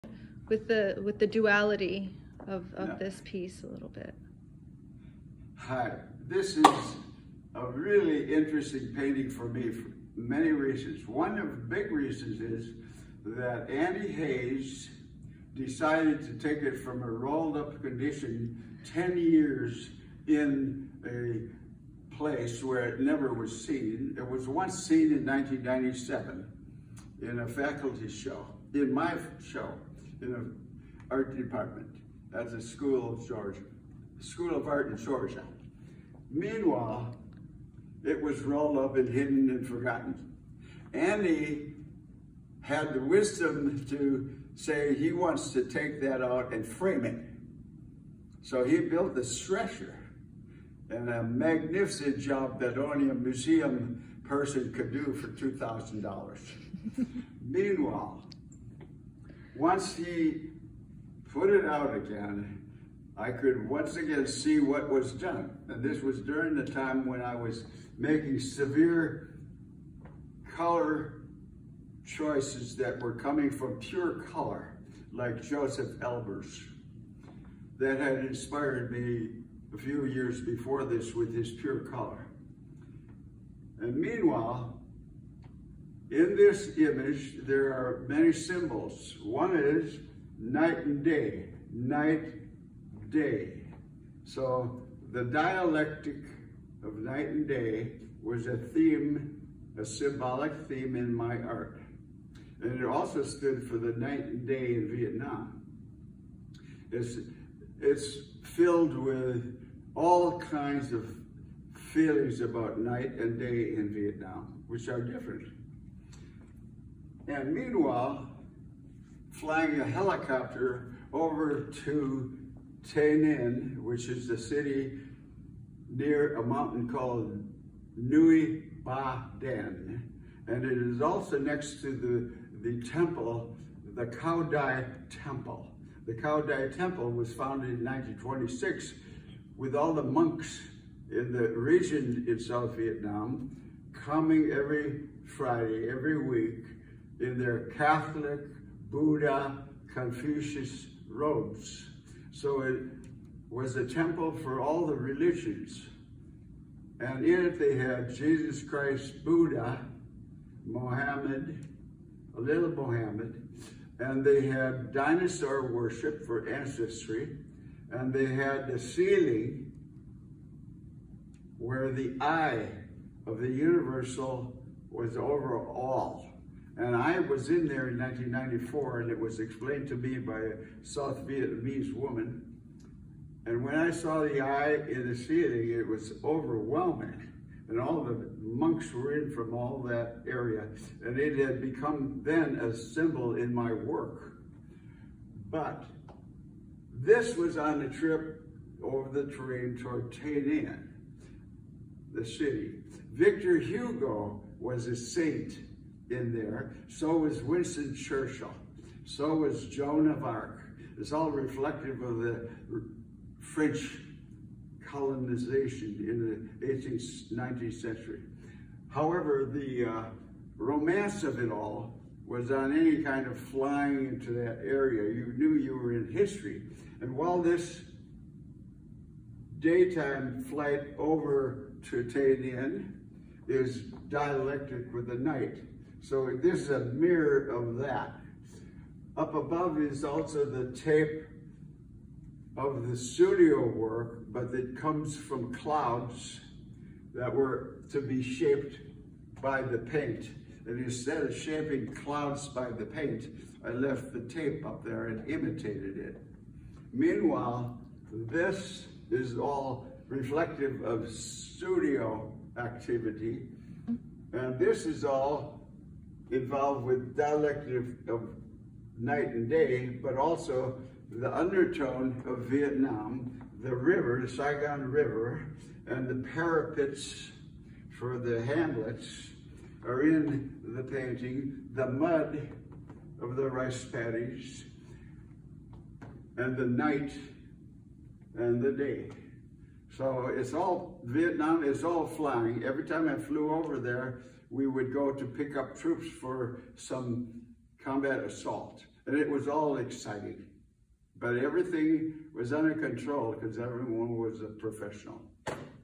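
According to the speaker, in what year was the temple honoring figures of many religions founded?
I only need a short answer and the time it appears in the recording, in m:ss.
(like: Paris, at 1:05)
1926, at 2:17.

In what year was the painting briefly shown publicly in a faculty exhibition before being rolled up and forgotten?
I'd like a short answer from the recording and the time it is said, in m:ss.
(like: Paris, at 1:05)
1997, at 0:25.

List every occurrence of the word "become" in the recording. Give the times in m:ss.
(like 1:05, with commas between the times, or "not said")
3:11.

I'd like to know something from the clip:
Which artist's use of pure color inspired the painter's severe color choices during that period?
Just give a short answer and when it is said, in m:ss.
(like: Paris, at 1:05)
Josef Albers, at 1:15.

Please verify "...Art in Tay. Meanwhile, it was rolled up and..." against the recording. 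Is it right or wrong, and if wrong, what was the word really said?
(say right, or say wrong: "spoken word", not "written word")
wrong: "Georgia", not "Tay".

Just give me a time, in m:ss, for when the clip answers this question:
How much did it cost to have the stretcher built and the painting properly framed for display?
0:55.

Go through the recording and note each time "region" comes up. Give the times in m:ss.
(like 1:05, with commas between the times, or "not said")
2:21.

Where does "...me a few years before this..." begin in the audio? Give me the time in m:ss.
1:18.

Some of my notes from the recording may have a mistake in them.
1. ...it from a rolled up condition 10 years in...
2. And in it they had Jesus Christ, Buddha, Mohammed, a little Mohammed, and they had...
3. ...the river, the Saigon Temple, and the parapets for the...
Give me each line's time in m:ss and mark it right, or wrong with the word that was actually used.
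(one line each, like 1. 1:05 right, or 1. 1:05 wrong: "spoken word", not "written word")
1. 0:16 right
2. 2:36 right
3. 4:33 wrong: "River", not "Temple".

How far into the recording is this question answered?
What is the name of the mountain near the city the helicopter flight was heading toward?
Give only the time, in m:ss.
2:07.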